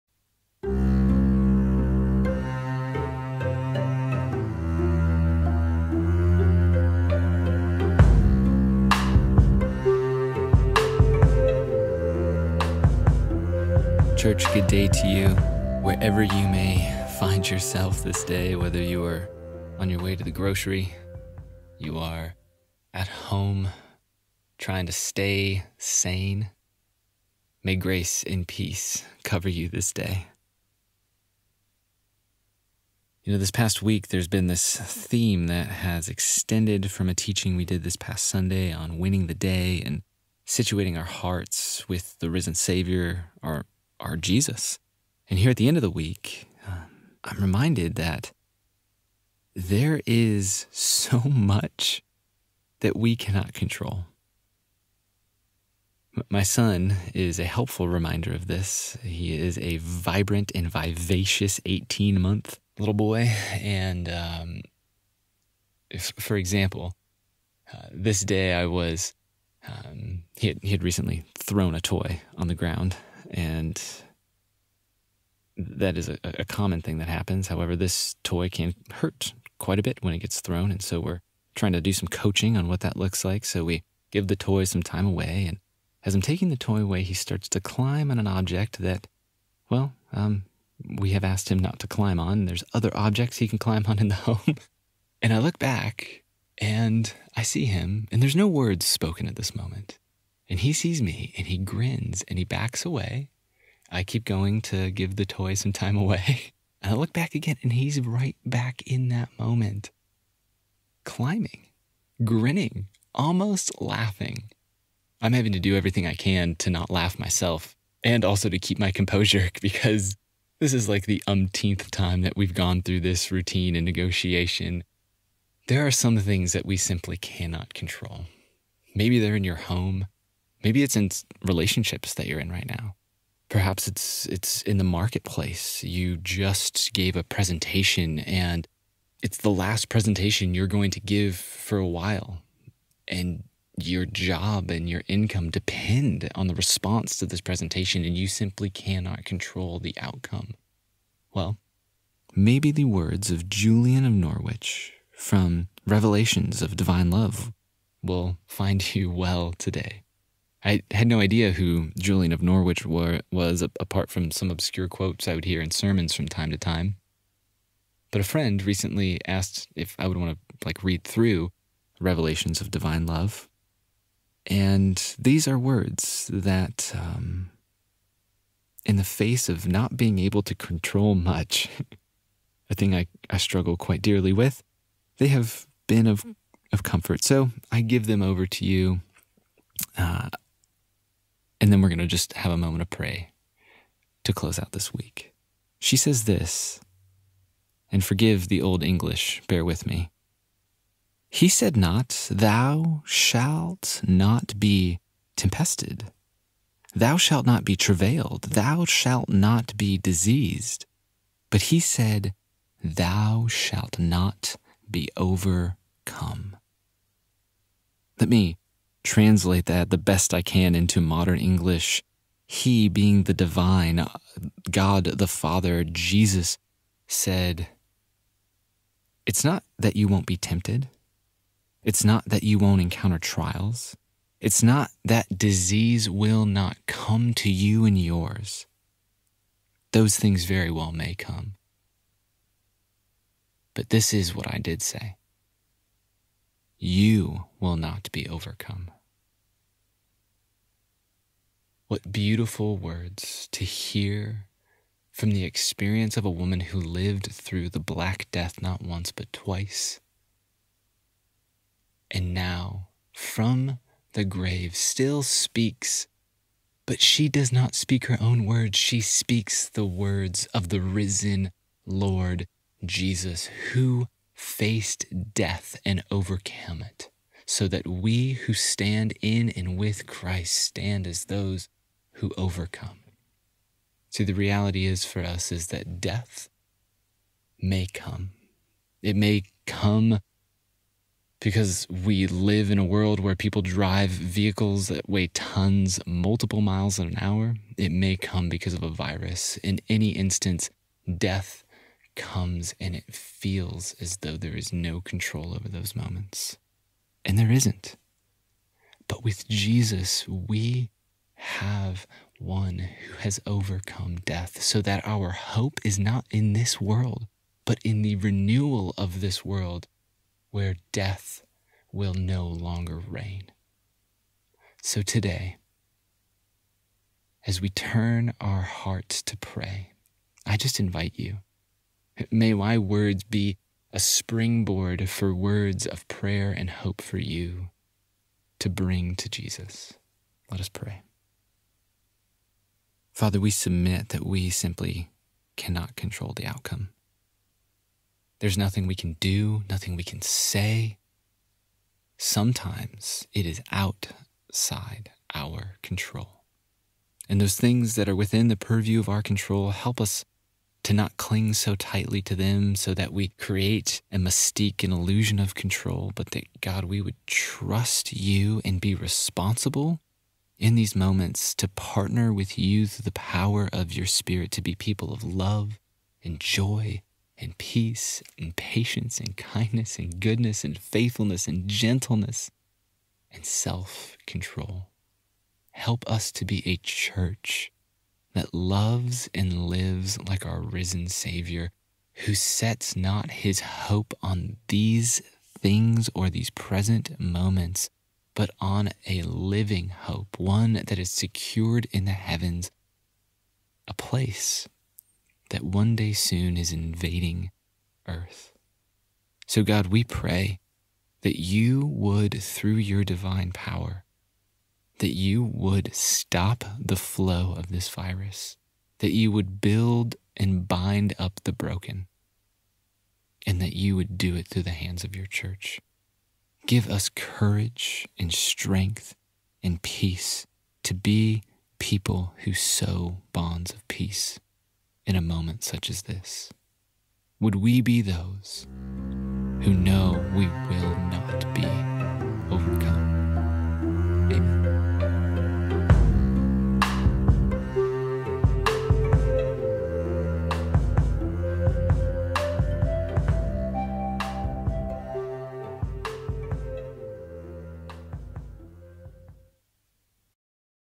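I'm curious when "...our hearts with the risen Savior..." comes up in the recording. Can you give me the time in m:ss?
0:40.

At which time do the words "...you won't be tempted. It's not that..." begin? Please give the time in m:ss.
3:49.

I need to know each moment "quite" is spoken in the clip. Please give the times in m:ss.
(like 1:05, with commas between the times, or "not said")
1:19, 3:03.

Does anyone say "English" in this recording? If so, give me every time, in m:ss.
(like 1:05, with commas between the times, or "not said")
3:18, 3:41.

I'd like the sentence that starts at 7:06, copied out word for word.
Give us courage and strength and peace to be people who sow bonds of peace in a moment such as this.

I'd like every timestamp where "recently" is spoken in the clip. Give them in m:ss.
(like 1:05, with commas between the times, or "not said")
1:10, 2:48.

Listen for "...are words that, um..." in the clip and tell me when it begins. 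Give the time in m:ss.
2:55.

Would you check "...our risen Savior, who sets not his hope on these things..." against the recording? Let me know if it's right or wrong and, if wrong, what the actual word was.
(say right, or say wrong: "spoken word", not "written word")
right.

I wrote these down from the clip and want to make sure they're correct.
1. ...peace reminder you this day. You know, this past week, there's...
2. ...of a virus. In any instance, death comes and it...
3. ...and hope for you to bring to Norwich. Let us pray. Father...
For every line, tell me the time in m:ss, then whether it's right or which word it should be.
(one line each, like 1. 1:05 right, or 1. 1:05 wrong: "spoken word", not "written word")
1. 0:28 wrong: "cover", not "reminder"
2. 4:58 right
3. 5:36 wrong: "Jesus", not "Norwich".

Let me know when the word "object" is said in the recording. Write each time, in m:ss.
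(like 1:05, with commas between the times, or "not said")
1:28, 1:32.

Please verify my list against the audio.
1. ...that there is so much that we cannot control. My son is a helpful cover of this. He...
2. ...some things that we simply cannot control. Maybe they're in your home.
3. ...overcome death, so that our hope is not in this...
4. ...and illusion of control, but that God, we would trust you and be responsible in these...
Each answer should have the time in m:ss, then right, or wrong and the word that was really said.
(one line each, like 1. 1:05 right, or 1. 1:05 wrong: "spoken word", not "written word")
1. 0:47 wrong: "reminder", not "cover"
2. 2:05 right
3. 5:13 right
4. 6:04 right.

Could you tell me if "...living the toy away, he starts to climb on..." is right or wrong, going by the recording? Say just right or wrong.
wrong.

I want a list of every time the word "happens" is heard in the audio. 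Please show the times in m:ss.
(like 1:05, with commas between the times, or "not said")
1:17.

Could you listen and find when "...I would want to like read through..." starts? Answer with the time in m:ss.
2:49.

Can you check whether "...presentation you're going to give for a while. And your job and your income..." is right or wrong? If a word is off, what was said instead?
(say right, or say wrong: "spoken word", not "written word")
right.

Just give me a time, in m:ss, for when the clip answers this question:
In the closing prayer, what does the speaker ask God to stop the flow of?
6:57.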